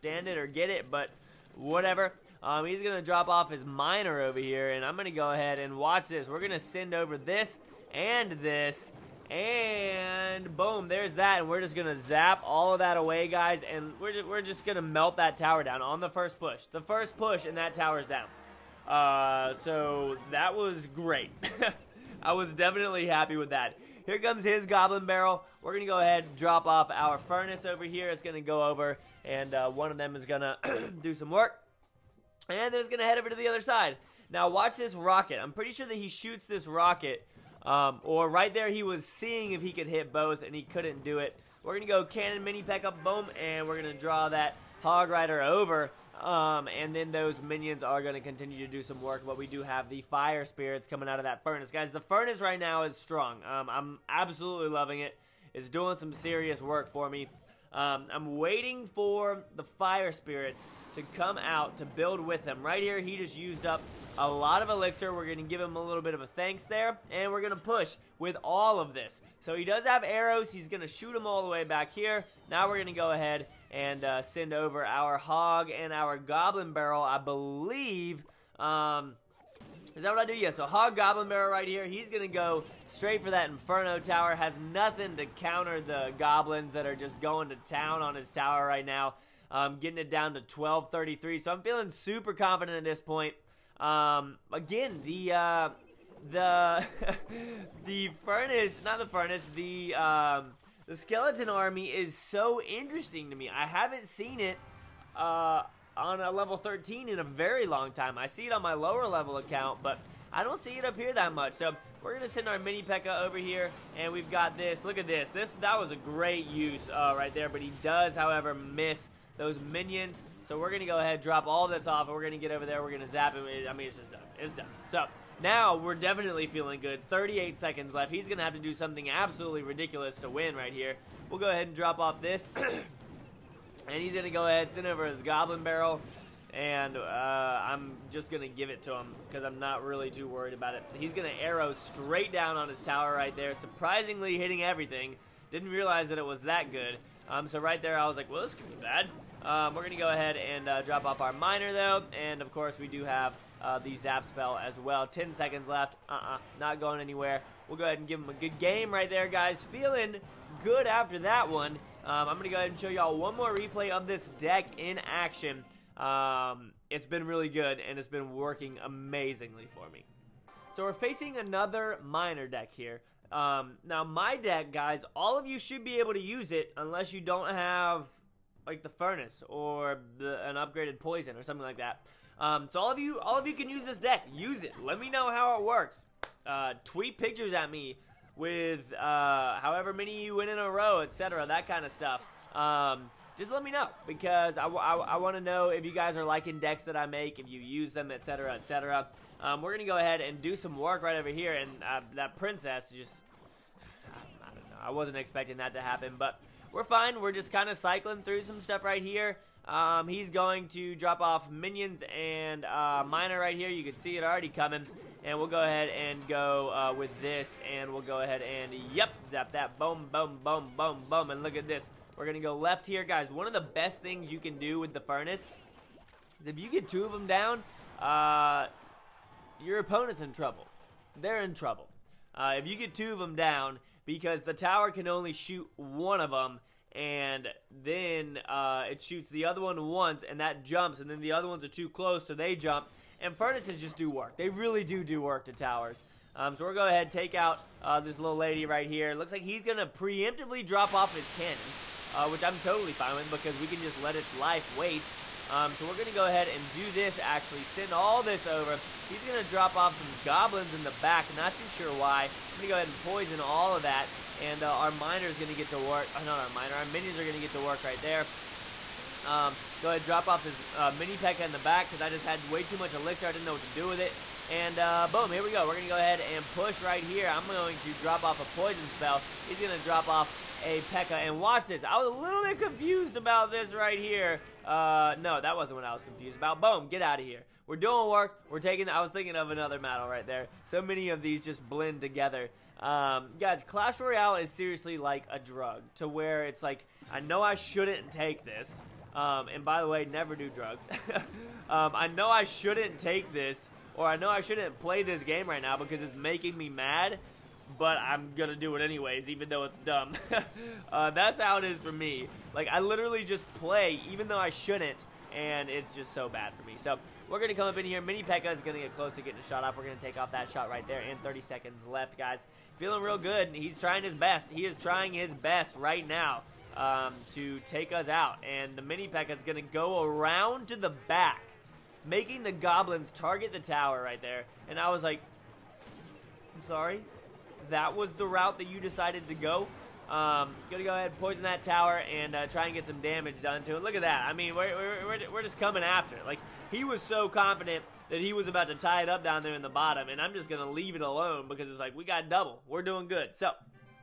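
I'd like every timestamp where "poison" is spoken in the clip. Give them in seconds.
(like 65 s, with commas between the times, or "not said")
180 s, 263 s, 278 s, 341 s.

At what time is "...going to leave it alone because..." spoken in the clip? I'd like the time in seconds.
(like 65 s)
350 s.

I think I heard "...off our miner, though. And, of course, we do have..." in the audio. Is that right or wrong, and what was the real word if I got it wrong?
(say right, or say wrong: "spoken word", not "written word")
right.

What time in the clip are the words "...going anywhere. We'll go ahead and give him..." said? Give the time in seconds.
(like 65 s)
156 s.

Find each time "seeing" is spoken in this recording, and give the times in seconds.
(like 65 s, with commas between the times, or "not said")
39 s.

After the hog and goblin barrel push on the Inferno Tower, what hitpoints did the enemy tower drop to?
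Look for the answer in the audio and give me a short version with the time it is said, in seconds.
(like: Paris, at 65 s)
1233, at 90 s.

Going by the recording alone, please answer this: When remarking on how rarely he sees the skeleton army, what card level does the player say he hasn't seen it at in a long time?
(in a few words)
13.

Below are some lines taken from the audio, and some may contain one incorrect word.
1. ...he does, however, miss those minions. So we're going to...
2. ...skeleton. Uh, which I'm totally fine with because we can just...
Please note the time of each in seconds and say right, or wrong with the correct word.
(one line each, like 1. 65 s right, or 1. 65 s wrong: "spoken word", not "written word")
1. 117 s right
2. 251 s wrong: "cannon", not "skeleton".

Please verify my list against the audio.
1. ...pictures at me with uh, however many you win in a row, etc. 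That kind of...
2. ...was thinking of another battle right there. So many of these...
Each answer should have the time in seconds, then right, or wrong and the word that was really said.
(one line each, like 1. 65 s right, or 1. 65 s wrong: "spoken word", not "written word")
1. 187 s right
2. 289 s right.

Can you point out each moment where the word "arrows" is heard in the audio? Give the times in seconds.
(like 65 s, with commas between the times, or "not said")
70 s, 141 s.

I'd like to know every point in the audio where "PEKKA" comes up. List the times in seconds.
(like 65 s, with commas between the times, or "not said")
112 s, 271 s, 280 s, 318 s, 329 s.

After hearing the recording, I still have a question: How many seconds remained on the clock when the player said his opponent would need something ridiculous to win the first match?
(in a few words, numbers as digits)
38.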